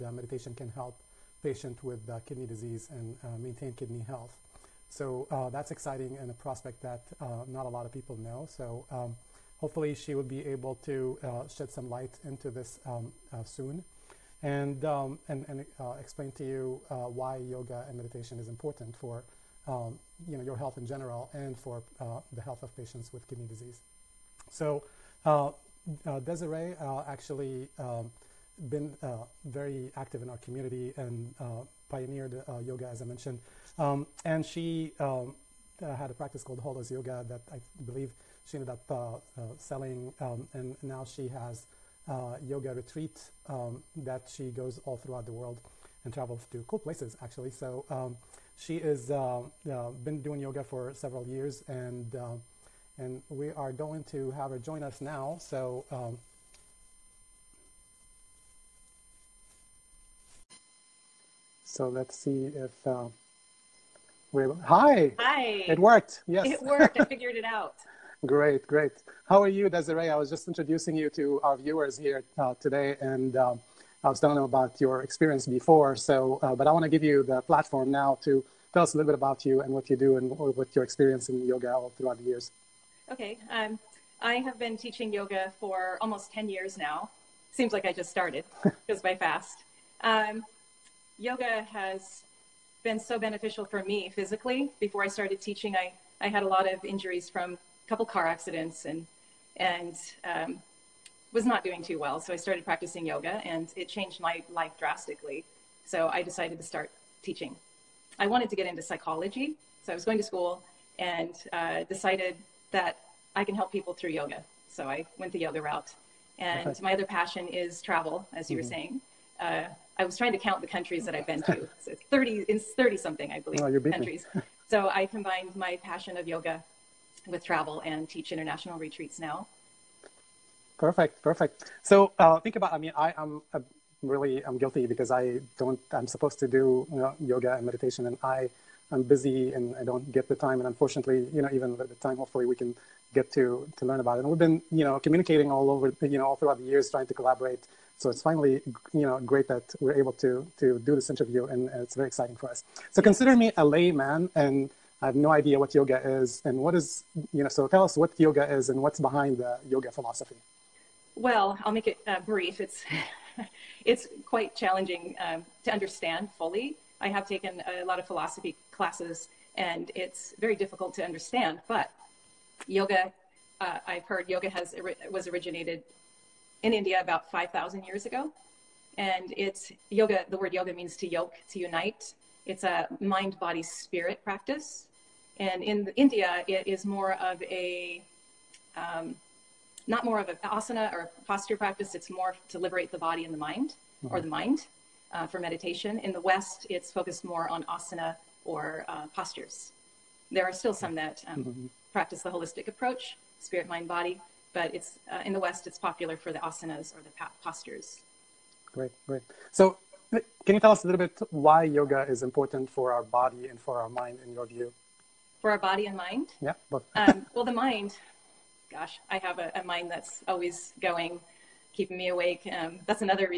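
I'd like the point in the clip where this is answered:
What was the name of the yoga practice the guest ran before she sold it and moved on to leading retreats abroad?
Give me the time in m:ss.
0:36.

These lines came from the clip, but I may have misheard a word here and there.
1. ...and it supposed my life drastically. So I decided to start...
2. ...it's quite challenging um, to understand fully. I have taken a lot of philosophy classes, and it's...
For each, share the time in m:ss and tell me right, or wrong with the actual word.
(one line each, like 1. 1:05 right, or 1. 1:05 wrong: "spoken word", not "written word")
1. 1:43 wrong: "changed", not "supposed"
2. 2:43 right.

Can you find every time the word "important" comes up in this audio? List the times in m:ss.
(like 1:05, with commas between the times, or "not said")
0:18, 3:32.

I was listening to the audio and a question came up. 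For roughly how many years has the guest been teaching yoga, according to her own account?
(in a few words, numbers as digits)
10.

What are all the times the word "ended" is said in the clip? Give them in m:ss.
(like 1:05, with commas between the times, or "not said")
0:38.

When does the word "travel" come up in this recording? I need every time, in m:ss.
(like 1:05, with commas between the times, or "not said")
0:46, 1:57, 2:07.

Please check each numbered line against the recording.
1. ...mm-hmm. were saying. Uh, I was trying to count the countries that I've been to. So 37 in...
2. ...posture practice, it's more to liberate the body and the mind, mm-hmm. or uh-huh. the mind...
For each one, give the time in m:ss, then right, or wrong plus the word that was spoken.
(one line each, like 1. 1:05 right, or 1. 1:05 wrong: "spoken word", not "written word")
1. 1:58 wrong: "30", not "37"
2. 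3:11 right.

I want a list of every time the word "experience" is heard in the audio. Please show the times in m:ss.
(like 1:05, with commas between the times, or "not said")
1:15, 1:20.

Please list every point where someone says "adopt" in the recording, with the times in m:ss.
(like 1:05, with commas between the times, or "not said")
not said.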